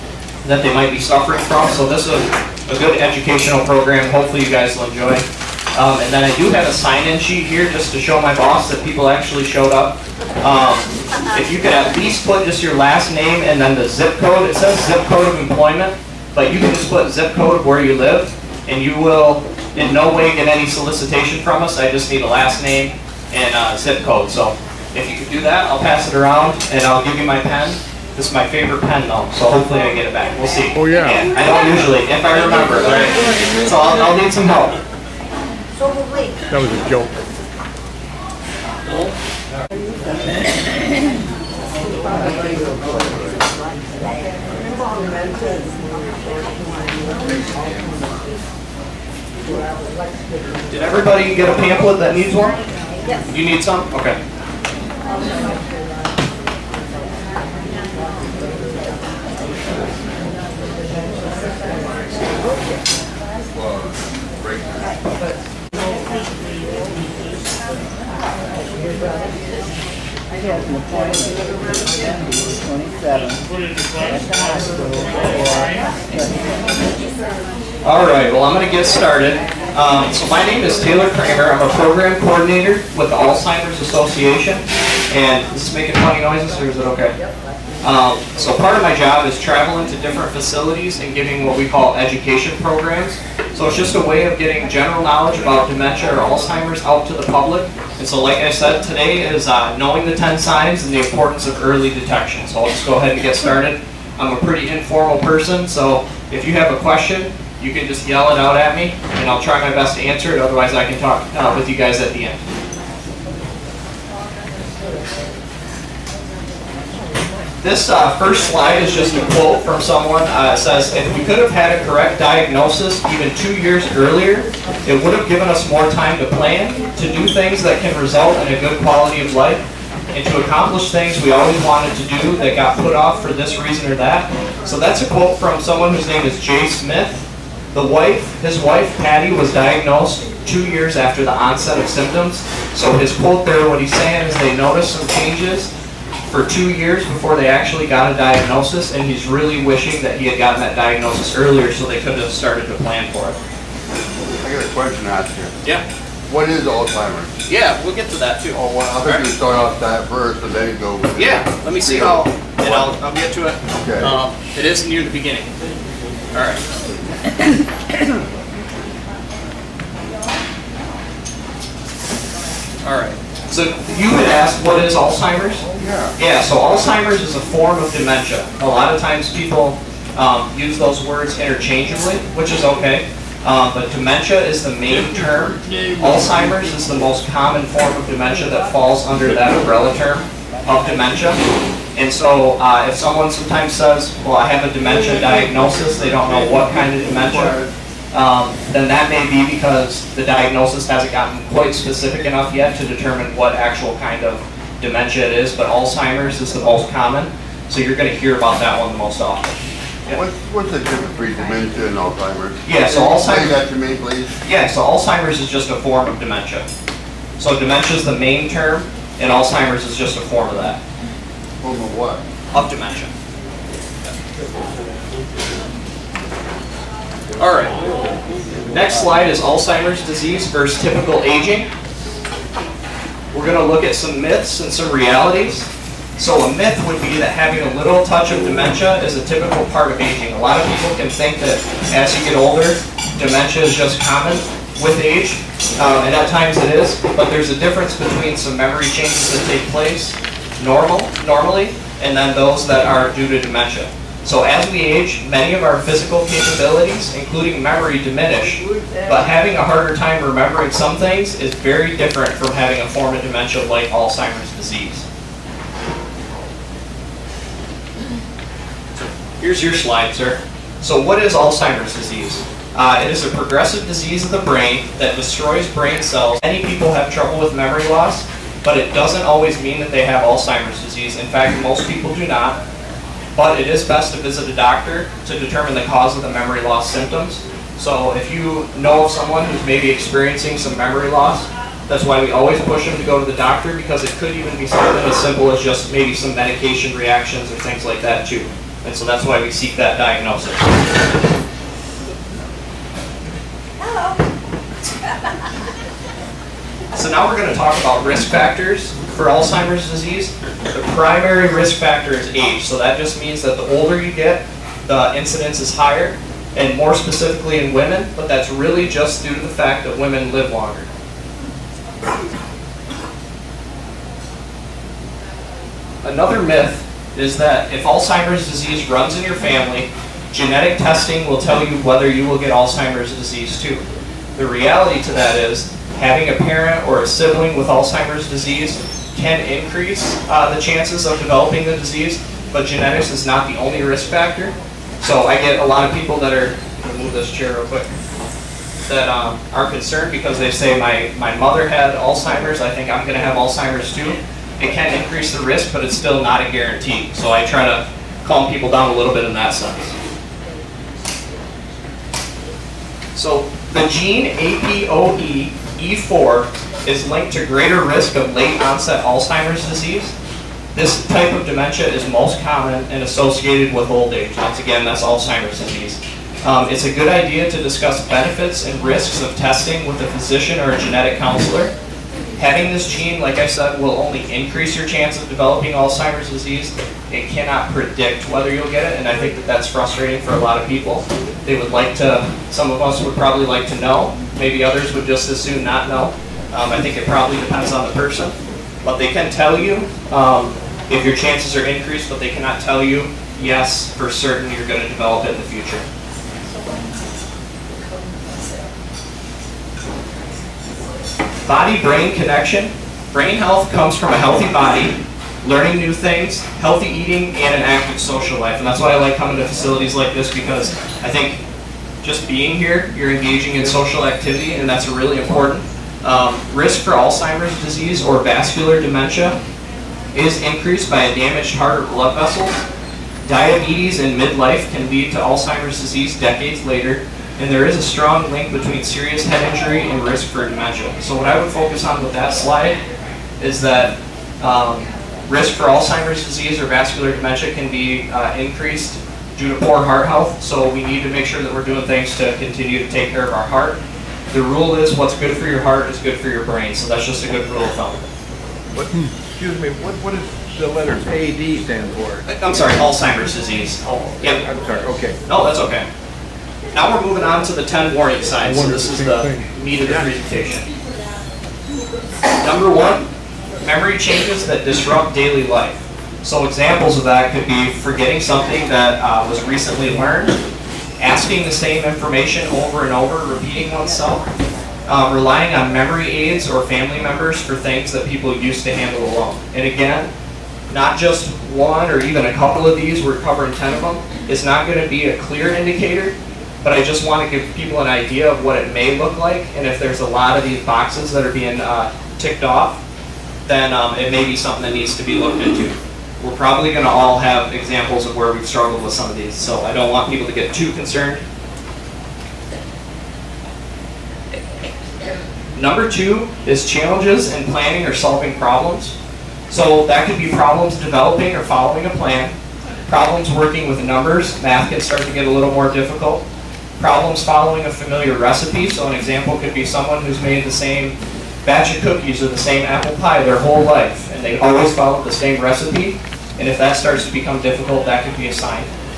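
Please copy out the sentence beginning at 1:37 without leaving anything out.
And so like I said, today is uh, knowing the 10 signs and the importance of early detection.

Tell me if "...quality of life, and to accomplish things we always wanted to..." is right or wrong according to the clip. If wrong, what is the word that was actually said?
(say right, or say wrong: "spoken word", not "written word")
right.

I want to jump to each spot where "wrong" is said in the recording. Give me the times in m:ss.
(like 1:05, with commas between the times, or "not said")
not said.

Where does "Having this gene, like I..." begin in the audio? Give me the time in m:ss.
6:22.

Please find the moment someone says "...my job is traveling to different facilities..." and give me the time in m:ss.
1:28.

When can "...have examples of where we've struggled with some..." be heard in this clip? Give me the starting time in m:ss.
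8:27.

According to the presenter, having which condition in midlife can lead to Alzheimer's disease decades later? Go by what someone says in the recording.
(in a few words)
Diabetes.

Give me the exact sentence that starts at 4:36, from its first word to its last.
Many people have trouble with memory loss, but it doesn't always mean that they have Alzheimer's disease.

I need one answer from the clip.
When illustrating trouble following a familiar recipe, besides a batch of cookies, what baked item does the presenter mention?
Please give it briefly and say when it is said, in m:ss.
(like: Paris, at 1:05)
apple pie, at 8:52.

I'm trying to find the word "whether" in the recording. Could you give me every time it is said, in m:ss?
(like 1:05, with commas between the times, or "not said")
5:31, 6:28.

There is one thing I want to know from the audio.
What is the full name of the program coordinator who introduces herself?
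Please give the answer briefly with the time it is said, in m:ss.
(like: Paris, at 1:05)
Taylor Kramer, at 1:20.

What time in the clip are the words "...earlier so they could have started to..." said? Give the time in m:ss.
2:31.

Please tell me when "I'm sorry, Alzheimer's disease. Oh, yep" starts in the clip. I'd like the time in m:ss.
7:42.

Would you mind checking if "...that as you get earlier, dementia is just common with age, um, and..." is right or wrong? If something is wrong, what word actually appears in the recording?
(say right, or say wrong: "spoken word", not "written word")
wrong: "older", not "earlier".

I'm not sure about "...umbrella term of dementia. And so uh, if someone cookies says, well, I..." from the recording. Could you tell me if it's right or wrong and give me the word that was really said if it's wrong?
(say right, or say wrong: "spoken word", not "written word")
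wrong: "sometimes", not "cookies".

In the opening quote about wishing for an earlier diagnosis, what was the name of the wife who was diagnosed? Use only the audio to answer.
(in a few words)
Patty.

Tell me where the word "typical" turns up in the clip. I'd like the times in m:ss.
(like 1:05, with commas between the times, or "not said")
3:50, 3:59.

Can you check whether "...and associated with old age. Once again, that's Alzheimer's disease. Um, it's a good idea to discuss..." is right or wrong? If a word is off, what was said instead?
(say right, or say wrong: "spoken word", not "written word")
right.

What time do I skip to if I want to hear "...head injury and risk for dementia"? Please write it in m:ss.
7:19.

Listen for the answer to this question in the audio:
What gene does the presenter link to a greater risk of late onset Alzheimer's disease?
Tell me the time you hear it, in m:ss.
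6:04.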